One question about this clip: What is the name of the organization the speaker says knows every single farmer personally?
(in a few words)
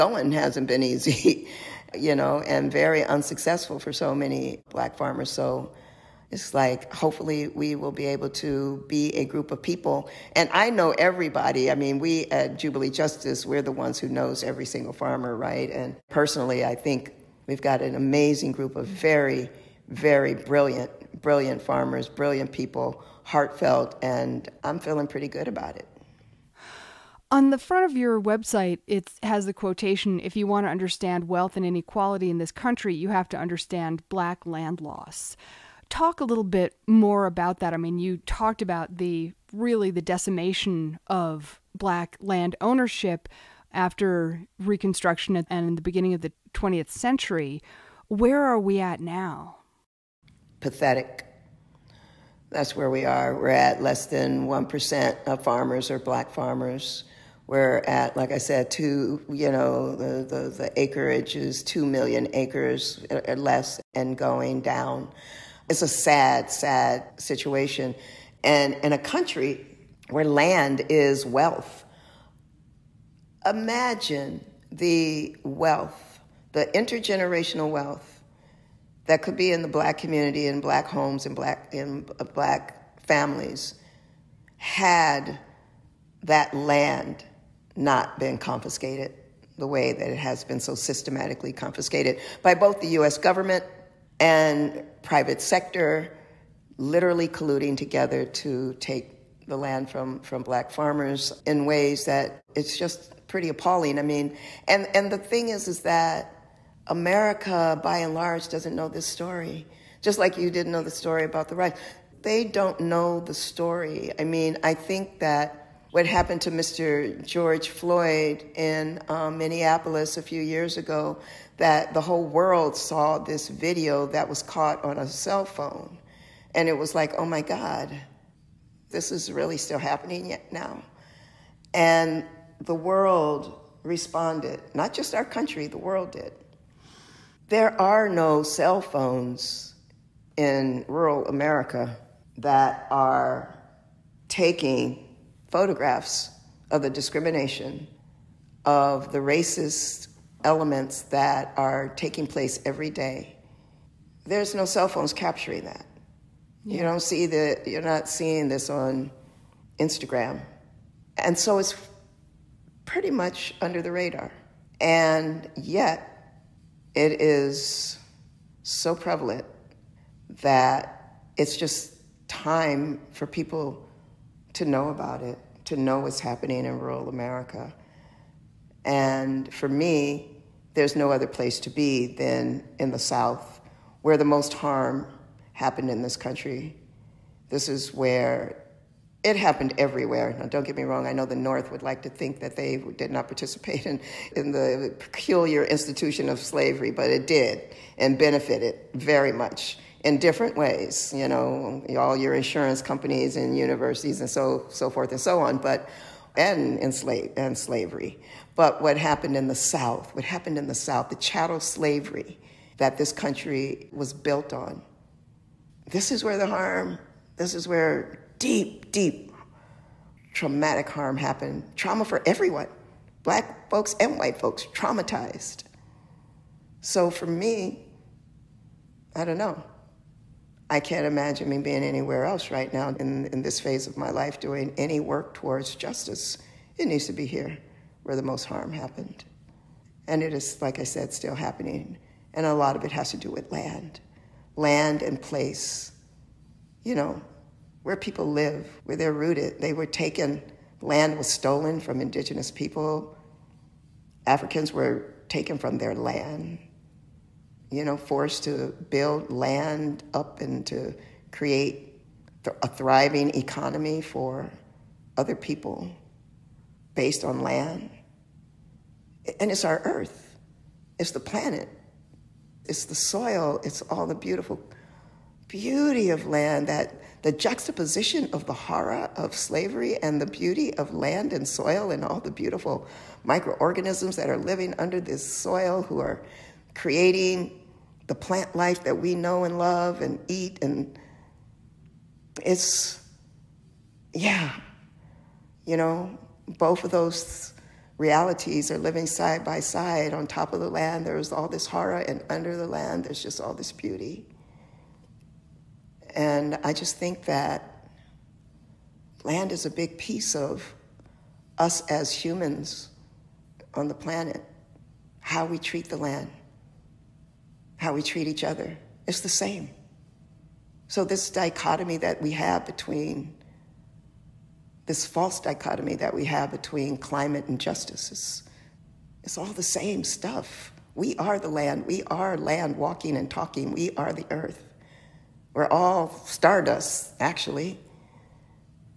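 Jubilee Justice.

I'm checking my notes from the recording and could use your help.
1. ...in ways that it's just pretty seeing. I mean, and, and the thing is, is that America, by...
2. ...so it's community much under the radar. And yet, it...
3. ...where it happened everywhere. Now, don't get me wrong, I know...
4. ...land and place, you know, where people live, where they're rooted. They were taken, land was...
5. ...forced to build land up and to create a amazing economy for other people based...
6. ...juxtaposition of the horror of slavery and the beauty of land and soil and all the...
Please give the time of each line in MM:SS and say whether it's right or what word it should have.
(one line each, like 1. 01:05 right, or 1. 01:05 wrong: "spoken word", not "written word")
1. 01:41 wrong: "appalling", not "seeing"
2. 02:41 wrong: "pretty", not "community"
3. 03:07 right
4. 04:04 right
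5. 04:17 wrong: "thriving", not "amazing"
6. 04:37 right.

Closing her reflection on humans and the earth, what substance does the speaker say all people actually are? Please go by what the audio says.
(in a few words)
stardust.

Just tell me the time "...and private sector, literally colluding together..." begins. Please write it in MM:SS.
01:34.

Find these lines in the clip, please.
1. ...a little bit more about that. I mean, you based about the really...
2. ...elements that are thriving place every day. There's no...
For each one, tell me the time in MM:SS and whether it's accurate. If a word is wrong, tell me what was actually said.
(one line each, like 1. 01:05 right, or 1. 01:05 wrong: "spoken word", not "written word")
1. 00:36 wrong: "talked", not "based"
2. 02:30 wrong: "taking", not "thriving".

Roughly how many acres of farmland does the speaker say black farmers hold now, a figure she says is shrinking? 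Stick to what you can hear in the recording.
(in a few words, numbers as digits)
2 million acres.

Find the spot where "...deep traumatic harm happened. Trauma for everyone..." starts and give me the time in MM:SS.
03:38.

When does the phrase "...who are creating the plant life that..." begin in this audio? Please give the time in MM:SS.
04:45.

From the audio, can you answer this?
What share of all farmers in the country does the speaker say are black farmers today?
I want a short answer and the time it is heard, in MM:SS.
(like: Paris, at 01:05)
less than 1%, at 00:53.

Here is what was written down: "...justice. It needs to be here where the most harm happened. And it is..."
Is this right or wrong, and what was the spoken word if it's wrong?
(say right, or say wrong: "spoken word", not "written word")
right.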